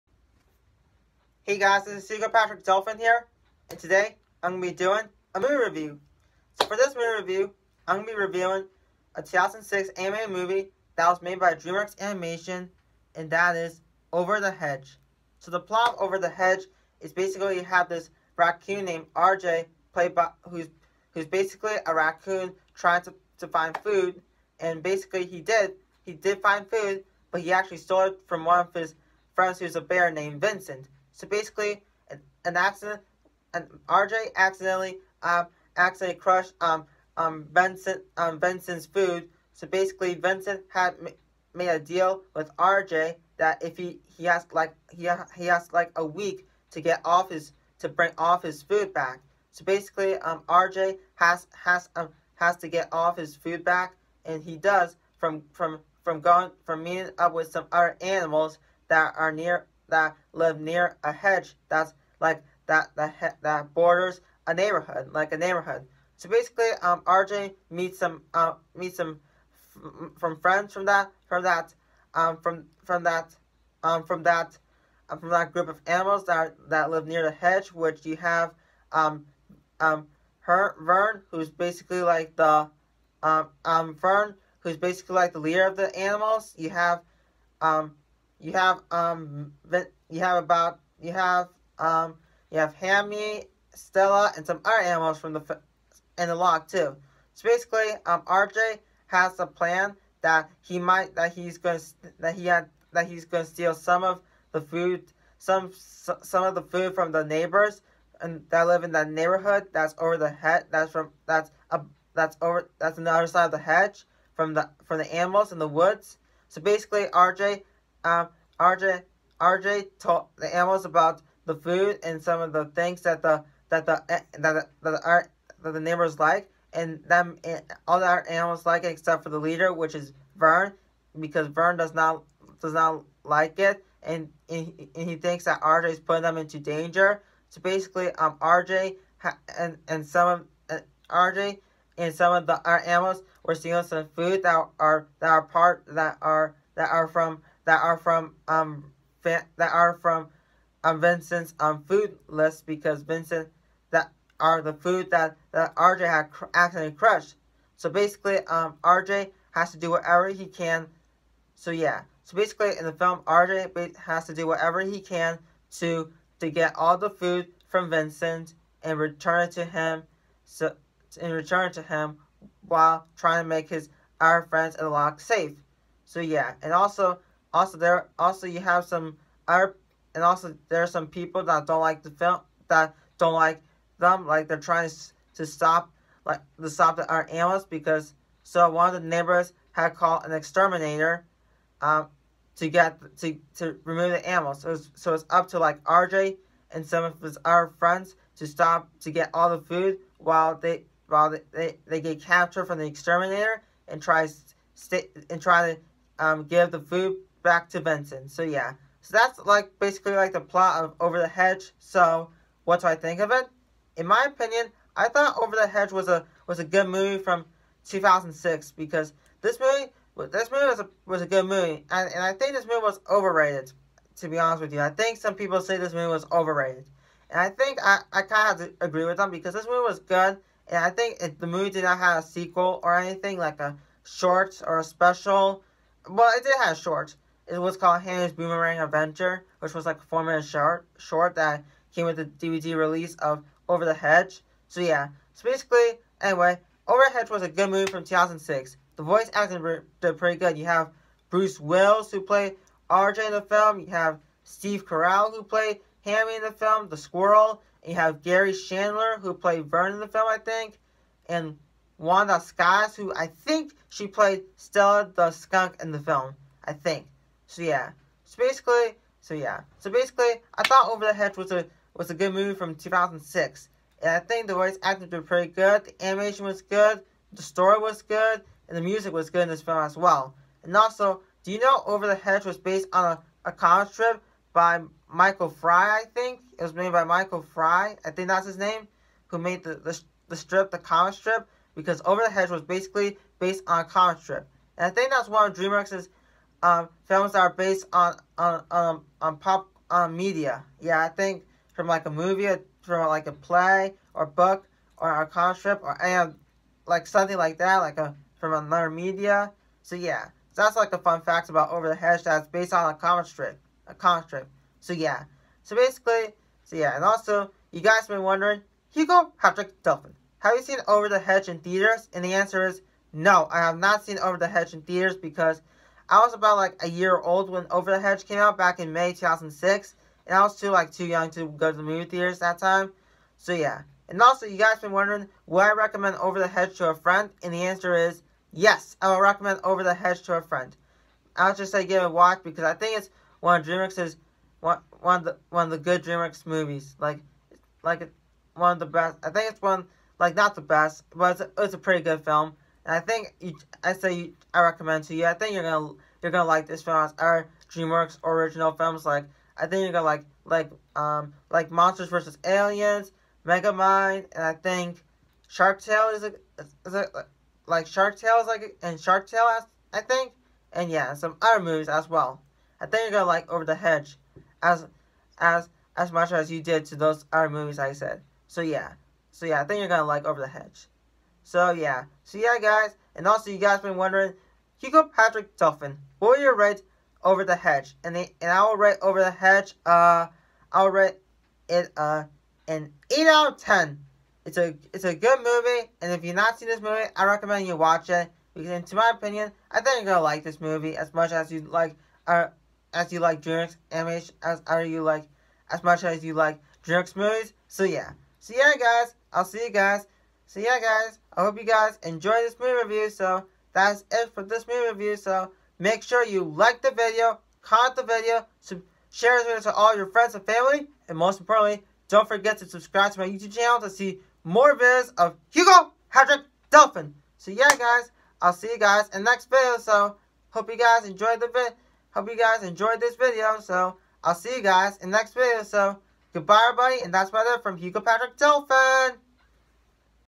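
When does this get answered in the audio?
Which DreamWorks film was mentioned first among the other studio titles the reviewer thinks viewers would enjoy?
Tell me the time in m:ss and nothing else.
6:01.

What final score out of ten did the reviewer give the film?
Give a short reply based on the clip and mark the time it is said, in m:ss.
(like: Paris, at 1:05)
8, at 6:32.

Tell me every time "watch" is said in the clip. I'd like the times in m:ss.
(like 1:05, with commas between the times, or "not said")
5:42, 6:37.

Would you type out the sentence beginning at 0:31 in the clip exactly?
So basically, an, an accident, an RJ accidentally um, accidentally crushed um um Vincent um Vincent's food.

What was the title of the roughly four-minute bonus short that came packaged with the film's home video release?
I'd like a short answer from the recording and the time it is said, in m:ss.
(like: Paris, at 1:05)
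Hammy's Boomerang Adventure, at 3:58.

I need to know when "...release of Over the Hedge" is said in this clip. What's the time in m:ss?
4:02.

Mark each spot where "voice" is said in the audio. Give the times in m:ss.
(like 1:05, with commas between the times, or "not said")
4:09, 4:34.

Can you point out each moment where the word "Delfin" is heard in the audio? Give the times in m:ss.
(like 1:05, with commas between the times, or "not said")
0:02, 5:19, 6:25, 7:06, 7:18.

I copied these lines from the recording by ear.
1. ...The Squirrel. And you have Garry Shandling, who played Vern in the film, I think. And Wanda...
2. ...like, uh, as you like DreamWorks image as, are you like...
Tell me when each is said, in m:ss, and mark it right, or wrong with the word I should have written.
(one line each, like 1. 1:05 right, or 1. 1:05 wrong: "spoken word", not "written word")
1. 4:16 right
2. 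6:41 right.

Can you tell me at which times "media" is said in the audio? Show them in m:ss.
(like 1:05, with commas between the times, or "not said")
5:00, 5:08.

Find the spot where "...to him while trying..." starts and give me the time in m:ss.
2:51.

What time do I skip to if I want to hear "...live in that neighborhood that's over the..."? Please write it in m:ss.
1:48.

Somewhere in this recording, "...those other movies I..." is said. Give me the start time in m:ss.
6:16.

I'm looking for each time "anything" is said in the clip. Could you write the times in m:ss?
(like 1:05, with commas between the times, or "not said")
3:52.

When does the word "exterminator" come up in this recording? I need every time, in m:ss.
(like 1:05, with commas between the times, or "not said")
3:10, 3:22.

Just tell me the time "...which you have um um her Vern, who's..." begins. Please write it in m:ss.
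1:17.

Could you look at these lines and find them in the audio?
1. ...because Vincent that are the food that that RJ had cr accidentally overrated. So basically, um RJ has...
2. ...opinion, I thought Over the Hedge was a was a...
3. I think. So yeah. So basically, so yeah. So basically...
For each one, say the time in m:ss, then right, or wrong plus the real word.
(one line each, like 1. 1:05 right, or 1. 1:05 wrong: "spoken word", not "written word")
1. 2:32 wrong: "crushed", not "overrated"
2. 3:34 right
3. 4:26 right.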